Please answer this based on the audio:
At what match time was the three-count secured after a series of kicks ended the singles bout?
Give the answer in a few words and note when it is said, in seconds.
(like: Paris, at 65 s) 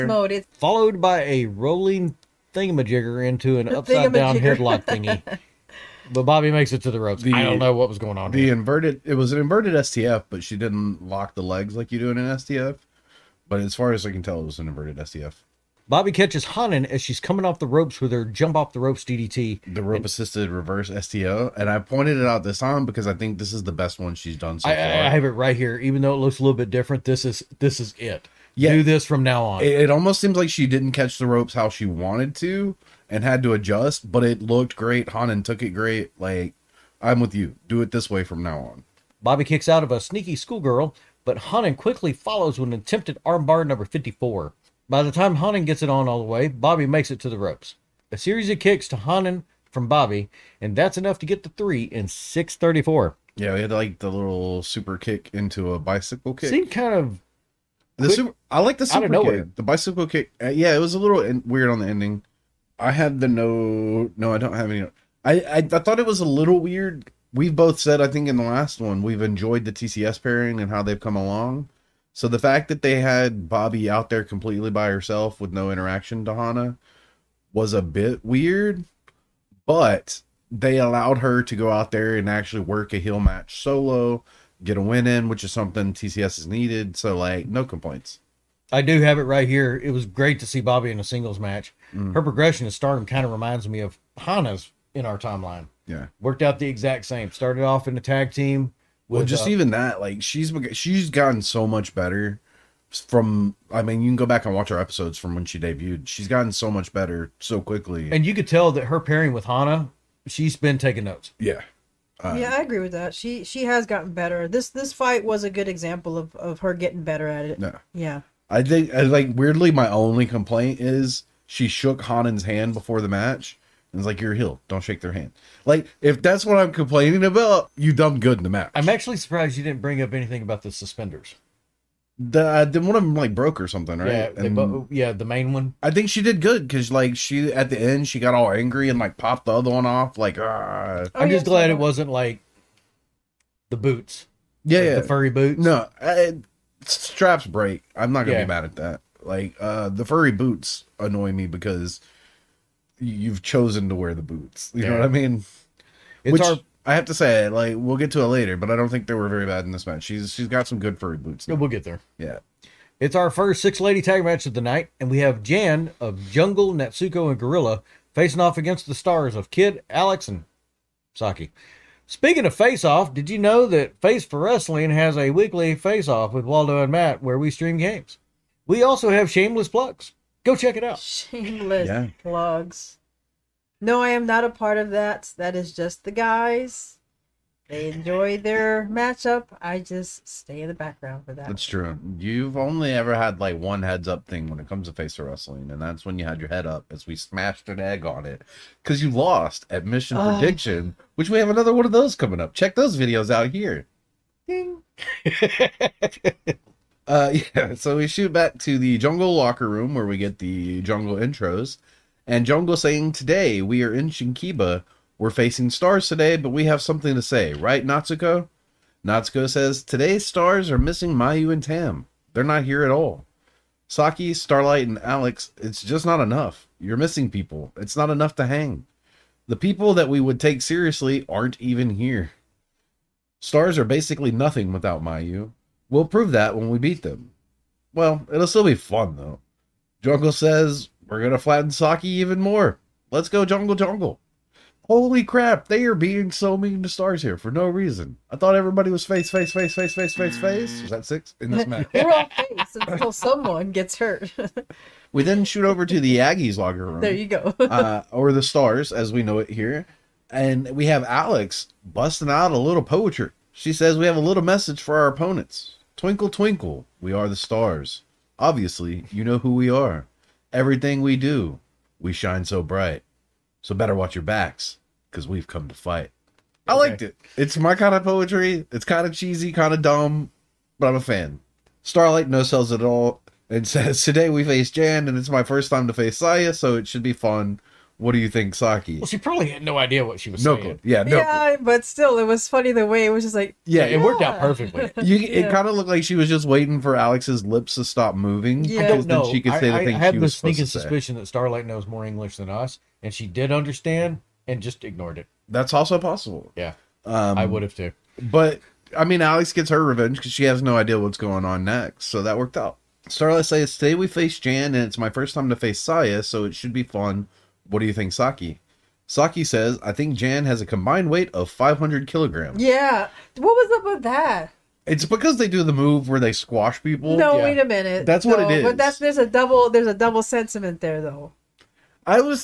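6:34, at 52 s.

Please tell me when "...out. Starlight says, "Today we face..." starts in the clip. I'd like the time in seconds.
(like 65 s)
312 s.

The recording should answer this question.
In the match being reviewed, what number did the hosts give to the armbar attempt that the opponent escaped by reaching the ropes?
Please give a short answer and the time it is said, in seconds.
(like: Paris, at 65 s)
54, at 43 s.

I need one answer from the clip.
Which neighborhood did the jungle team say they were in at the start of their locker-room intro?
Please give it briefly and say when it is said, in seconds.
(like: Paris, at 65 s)
Shinkiba, at 214 s.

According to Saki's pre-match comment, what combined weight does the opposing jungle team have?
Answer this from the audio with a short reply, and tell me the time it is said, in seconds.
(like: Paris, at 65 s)
500 kilograms, at 321 s.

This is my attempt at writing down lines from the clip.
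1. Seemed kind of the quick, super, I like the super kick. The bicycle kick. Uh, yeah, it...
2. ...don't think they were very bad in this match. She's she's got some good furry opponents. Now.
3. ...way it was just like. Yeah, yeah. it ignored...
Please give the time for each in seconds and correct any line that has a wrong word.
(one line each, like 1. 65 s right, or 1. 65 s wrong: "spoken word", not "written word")
1. 56 s right
2. 158 s wrong: "boots", not "opponents"
3. 292 s wrong: "worked", not "ignored".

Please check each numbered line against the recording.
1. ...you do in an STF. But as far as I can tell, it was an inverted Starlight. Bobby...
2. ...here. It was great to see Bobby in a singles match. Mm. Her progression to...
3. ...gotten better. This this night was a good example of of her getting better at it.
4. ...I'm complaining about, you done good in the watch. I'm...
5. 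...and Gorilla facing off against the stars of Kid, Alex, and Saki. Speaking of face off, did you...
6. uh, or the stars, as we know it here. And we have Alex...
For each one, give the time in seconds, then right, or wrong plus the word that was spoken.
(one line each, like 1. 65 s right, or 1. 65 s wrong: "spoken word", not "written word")
1. 11 s wrong: "STF", not "Starlight"
2. 89 s right
3. 113 s wrong: "fight", not "night"
4. 126 s wrong: "match", not "watch"
5. 167 s right
6. 257 s right.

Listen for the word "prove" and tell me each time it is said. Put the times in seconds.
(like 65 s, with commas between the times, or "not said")
236 s.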